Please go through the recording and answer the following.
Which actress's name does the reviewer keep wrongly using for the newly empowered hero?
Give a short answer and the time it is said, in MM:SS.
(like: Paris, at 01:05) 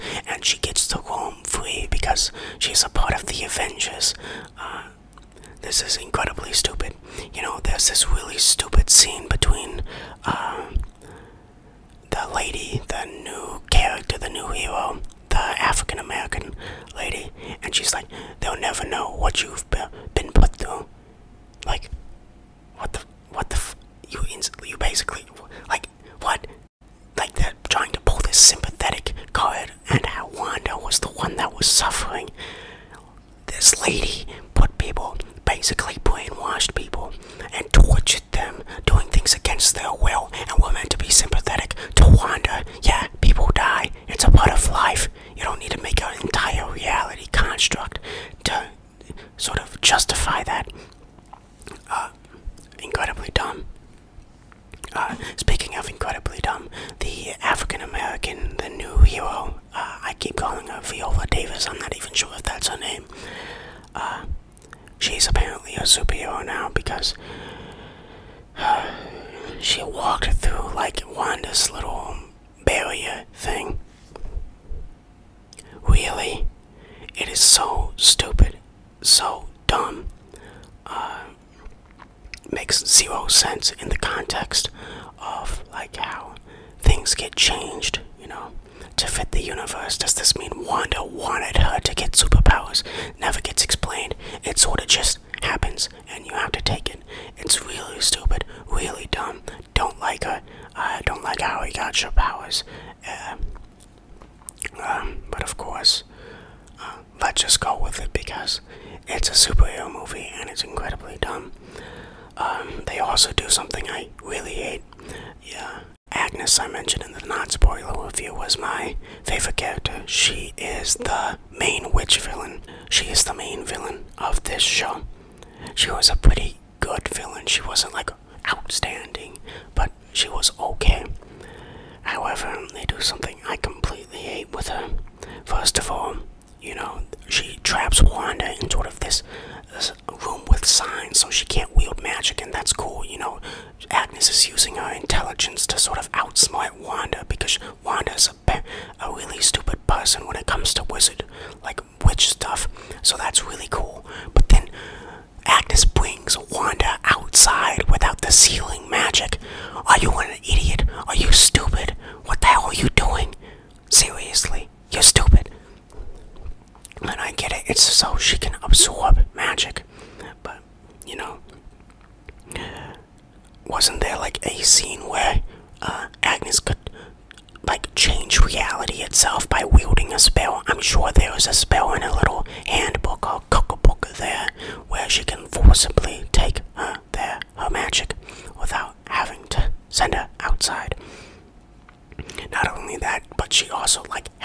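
Viola Davis, at 01:00.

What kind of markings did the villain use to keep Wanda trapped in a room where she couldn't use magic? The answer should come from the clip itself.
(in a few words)
signs.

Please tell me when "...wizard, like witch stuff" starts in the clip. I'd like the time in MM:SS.
02:30.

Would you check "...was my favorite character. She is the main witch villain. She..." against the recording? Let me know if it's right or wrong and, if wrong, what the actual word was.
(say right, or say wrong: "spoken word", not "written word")
right.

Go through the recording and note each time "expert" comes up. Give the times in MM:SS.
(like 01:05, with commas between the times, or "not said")
not said.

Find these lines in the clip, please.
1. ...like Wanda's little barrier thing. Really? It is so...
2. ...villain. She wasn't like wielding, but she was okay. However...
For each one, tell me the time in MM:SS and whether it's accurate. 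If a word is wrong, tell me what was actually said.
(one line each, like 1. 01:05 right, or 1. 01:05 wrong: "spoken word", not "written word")
1. 01:10 right
2. 02:07 wrong: "outstanding", not "wielding".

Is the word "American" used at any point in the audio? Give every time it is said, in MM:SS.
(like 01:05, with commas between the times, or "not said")
00:15, 00:57.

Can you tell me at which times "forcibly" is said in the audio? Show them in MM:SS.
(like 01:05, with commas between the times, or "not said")
03:05.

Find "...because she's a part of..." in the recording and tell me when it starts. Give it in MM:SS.
00:01.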